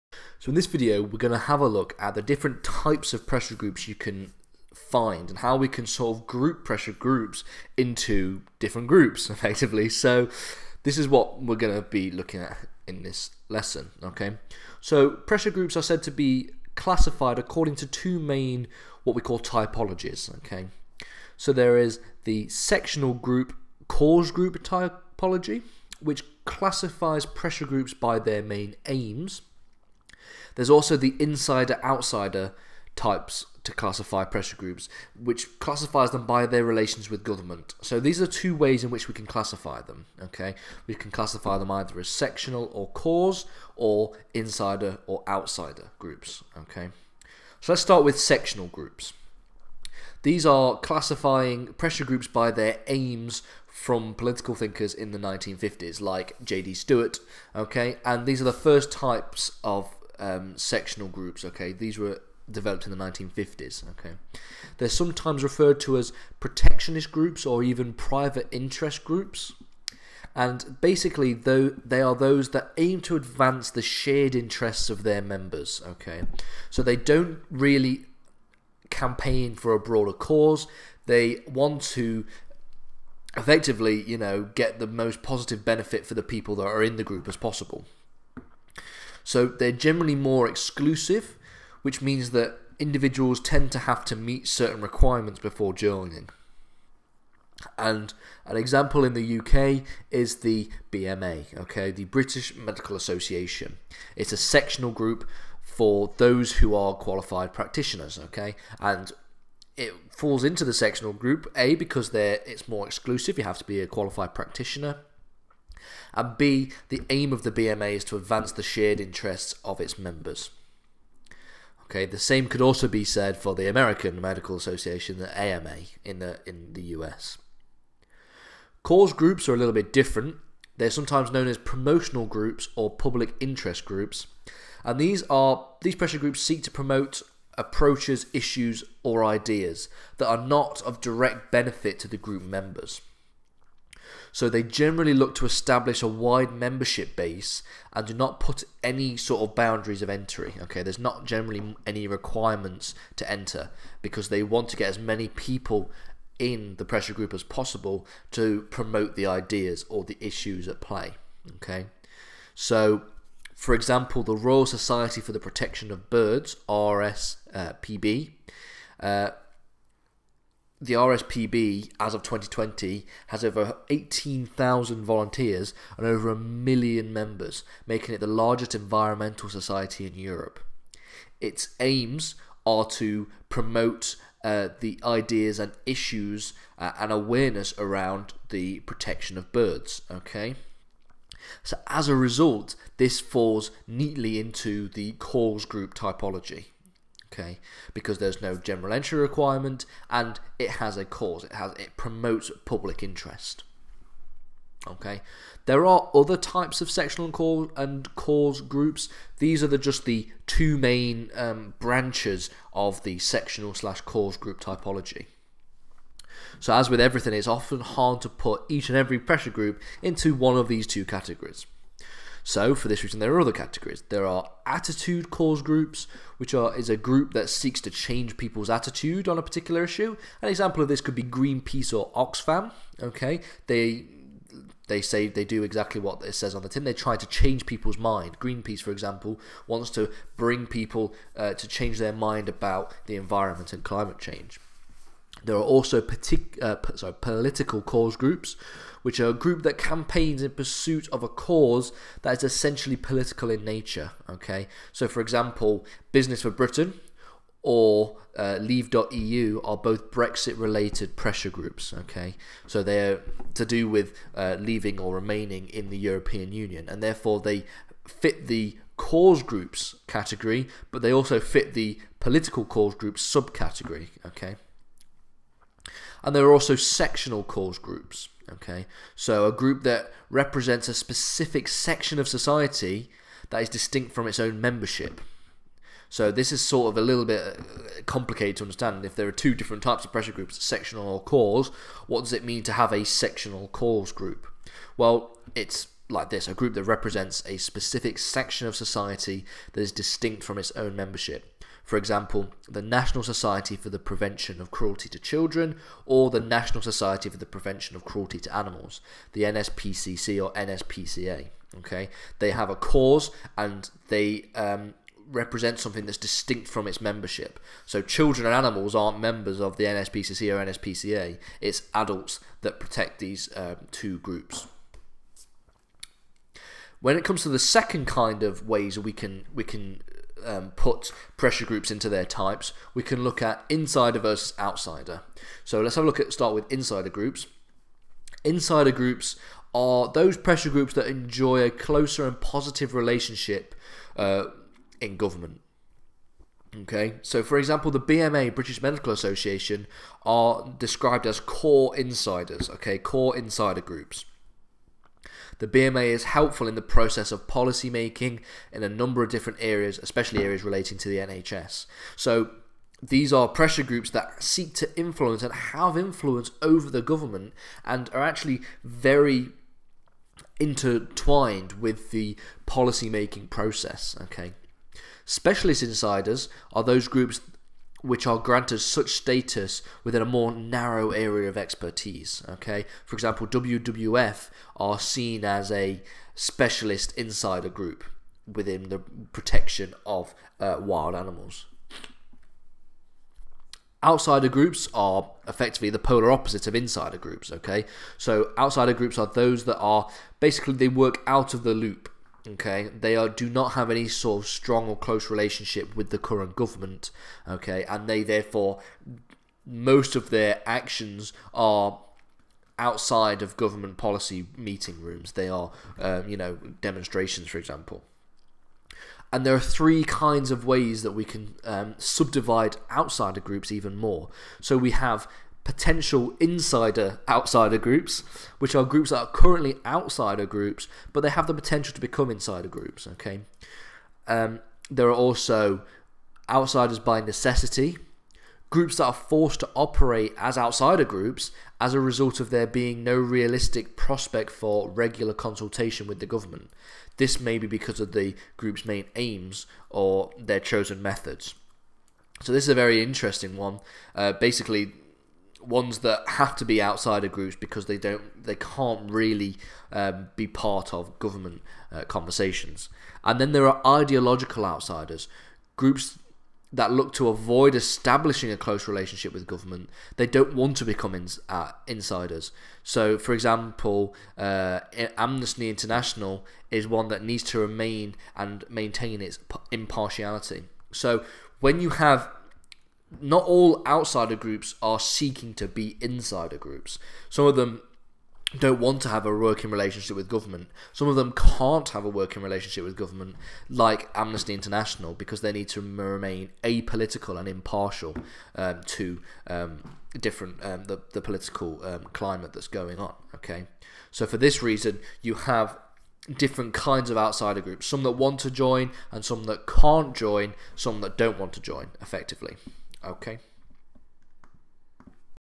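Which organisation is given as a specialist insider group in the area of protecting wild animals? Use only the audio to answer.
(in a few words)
WWF.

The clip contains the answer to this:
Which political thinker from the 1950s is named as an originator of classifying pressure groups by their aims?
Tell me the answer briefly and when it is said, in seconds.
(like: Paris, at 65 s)
J.D. Stewart, at 56 s.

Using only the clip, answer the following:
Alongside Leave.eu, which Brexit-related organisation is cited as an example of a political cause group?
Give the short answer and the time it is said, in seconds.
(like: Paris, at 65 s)
Business for Britain, at 256 s.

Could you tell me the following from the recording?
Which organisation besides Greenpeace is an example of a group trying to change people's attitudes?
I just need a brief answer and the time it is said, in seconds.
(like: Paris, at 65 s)
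Oxfam, at 232 s.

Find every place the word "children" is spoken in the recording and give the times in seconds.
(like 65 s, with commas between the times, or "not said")
305 s, 318 s.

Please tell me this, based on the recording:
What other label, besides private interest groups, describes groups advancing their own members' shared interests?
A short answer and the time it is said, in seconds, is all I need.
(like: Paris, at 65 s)
protectionist groups, at 66 s.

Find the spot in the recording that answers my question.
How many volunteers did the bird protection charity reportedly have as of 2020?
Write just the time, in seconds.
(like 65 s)
173 s.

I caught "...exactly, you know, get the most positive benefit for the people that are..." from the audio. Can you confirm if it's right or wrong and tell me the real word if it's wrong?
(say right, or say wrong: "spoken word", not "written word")
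wrong: "effectively", not "exactly".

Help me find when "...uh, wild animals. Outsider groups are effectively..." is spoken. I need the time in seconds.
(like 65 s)
390 s.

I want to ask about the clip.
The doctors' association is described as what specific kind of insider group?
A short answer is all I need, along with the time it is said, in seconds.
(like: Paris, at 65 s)
core insiders, at 351 s.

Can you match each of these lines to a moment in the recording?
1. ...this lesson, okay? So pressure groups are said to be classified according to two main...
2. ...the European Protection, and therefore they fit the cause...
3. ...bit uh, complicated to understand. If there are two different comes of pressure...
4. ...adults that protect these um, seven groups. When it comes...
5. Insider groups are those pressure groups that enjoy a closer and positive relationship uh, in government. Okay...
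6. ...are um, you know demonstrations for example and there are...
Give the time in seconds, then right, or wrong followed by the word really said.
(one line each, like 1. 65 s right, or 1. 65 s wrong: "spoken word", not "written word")
1. 13 s right
2. 265 s wrong: "Union", not "Protection"
3. 287 s wrong: "types", not "comes"
4. 321 s wrong: "two", not "seven"
5. 338 s right
6. 415 s right.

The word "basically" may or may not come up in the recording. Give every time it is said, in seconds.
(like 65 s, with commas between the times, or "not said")
70 s, 400 s, 454 s.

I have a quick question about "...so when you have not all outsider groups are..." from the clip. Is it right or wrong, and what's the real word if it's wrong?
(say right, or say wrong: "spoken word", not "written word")
right.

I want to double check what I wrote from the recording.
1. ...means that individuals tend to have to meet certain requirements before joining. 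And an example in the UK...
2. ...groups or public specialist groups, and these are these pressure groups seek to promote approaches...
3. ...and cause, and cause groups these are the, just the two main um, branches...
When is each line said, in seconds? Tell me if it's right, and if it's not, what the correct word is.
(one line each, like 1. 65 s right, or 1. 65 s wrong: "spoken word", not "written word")
1. 92 s right
2. 132 s wrong: "interest", not "specialist"
3. 207 s right.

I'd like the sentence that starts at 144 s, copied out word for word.
So they generally look to establish a wide membership base and do not put any sort of boundaries of entry.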